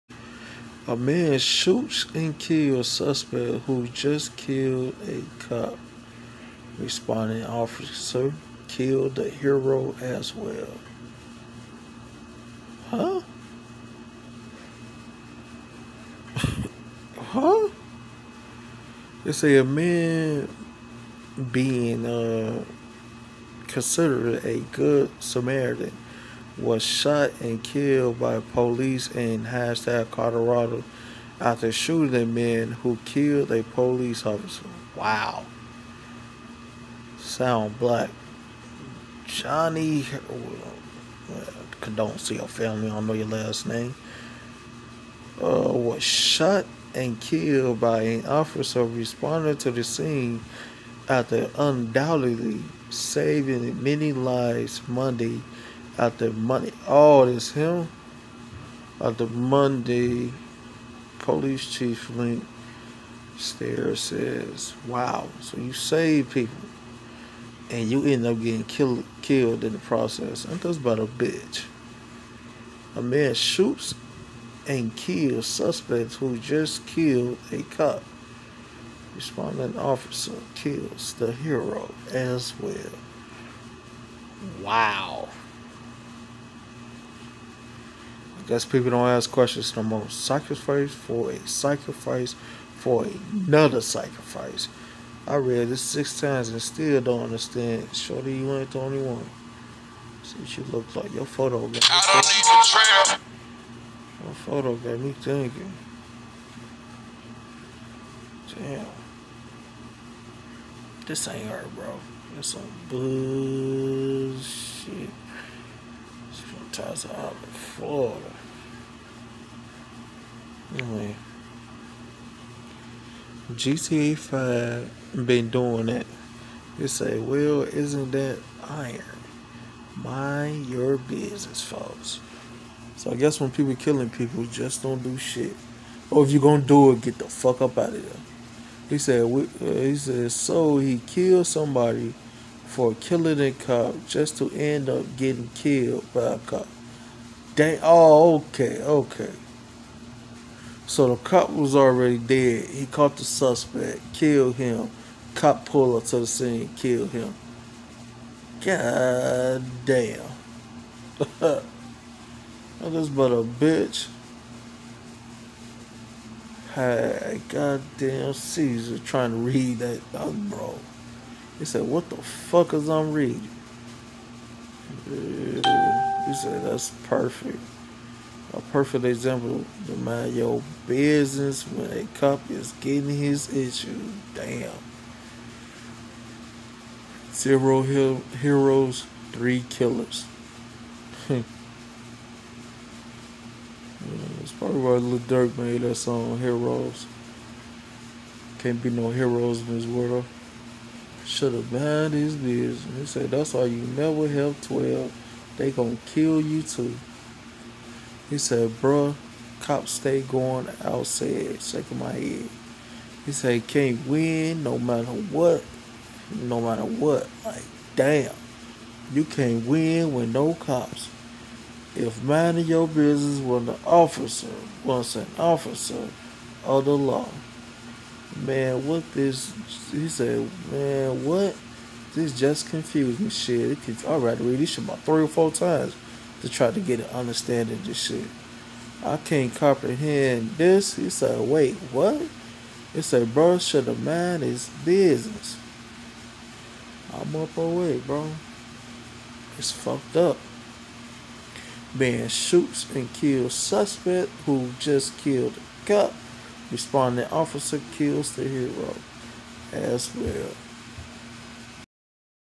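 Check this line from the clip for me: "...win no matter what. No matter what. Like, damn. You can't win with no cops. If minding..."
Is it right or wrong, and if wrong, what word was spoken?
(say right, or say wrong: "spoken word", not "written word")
right.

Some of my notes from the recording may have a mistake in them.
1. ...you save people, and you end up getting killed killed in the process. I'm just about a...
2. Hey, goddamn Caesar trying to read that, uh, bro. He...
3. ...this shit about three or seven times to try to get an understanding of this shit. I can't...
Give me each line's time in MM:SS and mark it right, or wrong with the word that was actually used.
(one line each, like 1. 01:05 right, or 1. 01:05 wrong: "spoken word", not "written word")
1. 01:05 right
2. 02:46 right
3. 03:54 wrong: "four", not "seven".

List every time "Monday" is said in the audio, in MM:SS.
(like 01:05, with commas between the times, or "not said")
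00:54, 00:59.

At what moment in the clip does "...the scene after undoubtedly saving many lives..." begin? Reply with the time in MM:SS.
00:49.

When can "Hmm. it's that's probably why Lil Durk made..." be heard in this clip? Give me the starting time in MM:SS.
03:11.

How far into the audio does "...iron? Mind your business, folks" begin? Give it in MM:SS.
02:08.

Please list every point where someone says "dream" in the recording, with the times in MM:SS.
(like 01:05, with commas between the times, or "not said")
not said.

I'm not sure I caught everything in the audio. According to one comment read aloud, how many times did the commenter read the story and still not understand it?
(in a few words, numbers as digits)
6.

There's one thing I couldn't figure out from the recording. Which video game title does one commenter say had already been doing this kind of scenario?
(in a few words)
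GTA 5.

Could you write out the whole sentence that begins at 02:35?
Cop pulled up to the scene, killed him.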